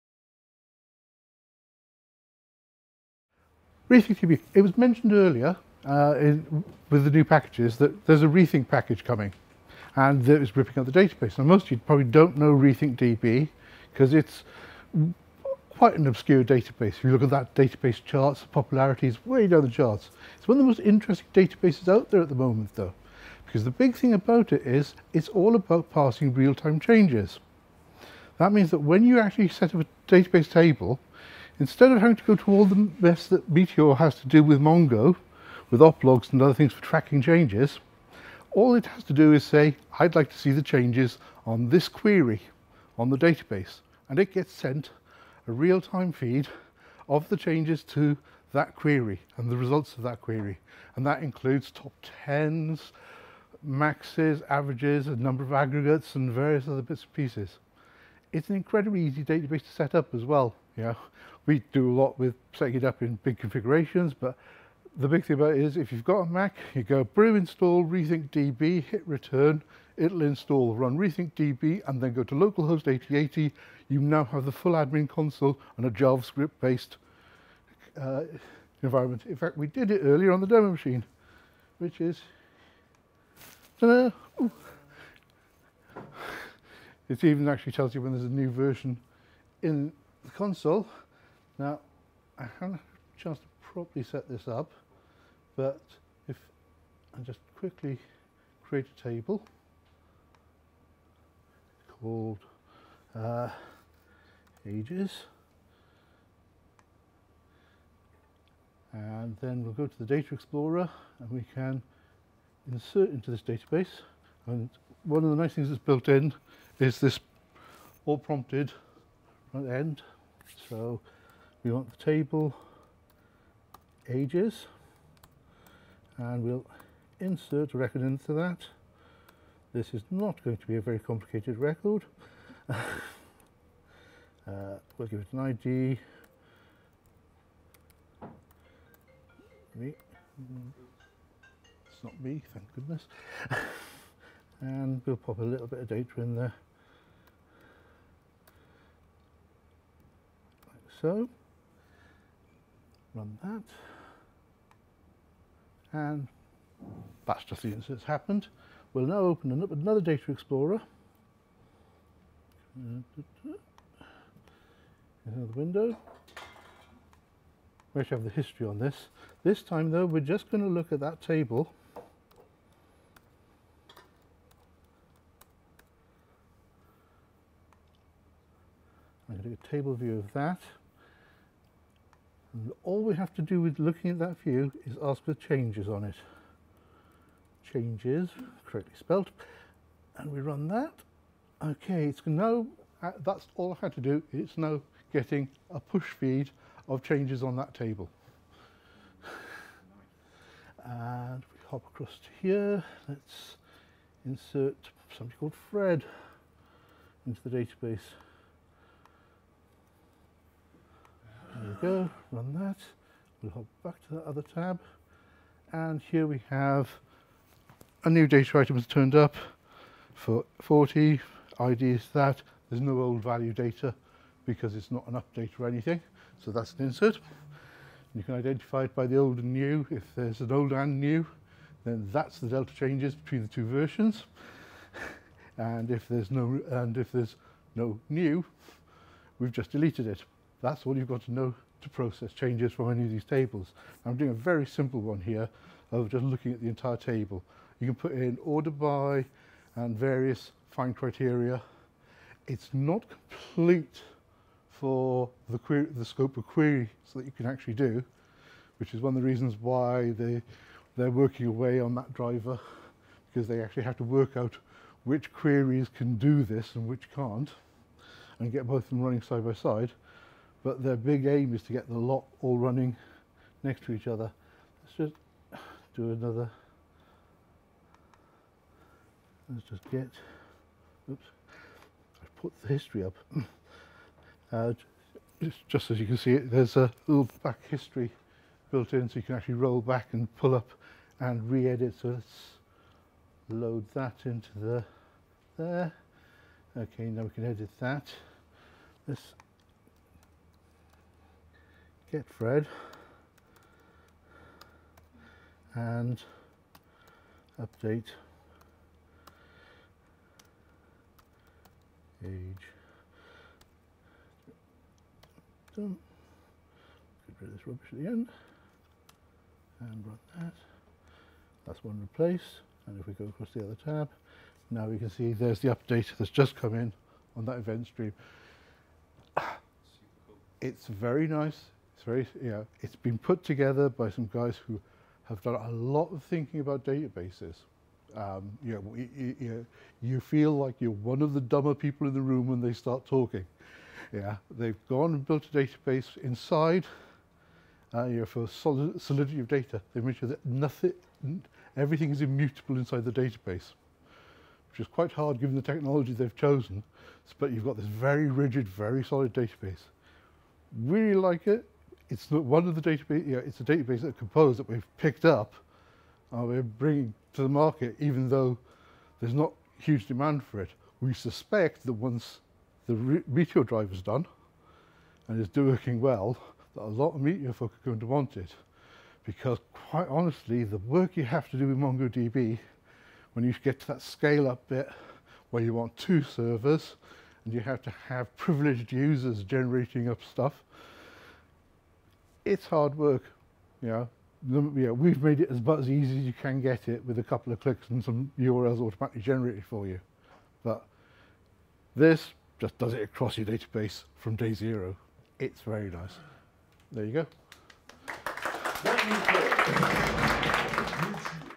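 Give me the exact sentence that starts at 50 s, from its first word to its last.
And that includes top 10s, maxes, averages, a number of aggregates and various other bits and pieces.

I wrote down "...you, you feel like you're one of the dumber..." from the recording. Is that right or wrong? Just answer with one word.
right.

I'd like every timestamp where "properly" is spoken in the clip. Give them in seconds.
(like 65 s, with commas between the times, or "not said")
93 s.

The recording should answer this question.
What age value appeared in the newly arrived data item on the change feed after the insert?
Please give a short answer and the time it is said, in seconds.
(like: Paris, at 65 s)
40, at 220 s.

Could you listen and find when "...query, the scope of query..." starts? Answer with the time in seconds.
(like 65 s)
255 s.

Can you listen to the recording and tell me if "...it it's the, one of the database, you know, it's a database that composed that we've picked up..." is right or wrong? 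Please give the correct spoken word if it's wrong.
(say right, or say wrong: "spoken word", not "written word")
right.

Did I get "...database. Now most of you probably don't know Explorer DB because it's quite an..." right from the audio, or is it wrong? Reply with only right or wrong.
wrong.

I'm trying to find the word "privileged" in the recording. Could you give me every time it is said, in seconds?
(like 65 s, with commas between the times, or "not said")
388 s.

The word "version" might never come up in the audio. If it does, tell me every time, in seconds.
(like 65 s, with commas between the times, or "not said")
88 s, 233 s.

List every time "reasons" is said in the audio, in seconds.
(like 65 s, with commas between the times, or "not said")
259 s.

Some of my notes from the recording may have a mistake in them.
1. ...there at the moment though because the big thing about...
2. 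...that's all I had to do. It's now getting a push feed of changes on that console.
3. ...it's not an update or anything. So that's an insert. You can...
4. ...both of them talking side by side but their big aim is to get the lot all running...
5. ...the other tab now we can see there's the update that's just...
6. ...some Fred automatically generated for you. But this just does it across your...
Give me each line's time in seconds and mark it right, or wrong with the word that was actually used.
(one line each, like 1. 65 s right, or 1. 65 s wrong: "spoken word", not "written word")
1. 22 s right
2. 193 s wrong: "table", not "console"
3. 224 s right
4. 268 s wrong: "running", not "talking"
5. 323 s right
6. 398 s wrong: "URLs", not "Fred".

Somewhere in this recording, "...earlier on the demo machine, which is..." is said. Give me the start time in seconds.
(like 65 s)
80 s.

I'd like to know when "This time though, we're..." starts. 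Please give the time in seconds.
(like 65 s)
169 s.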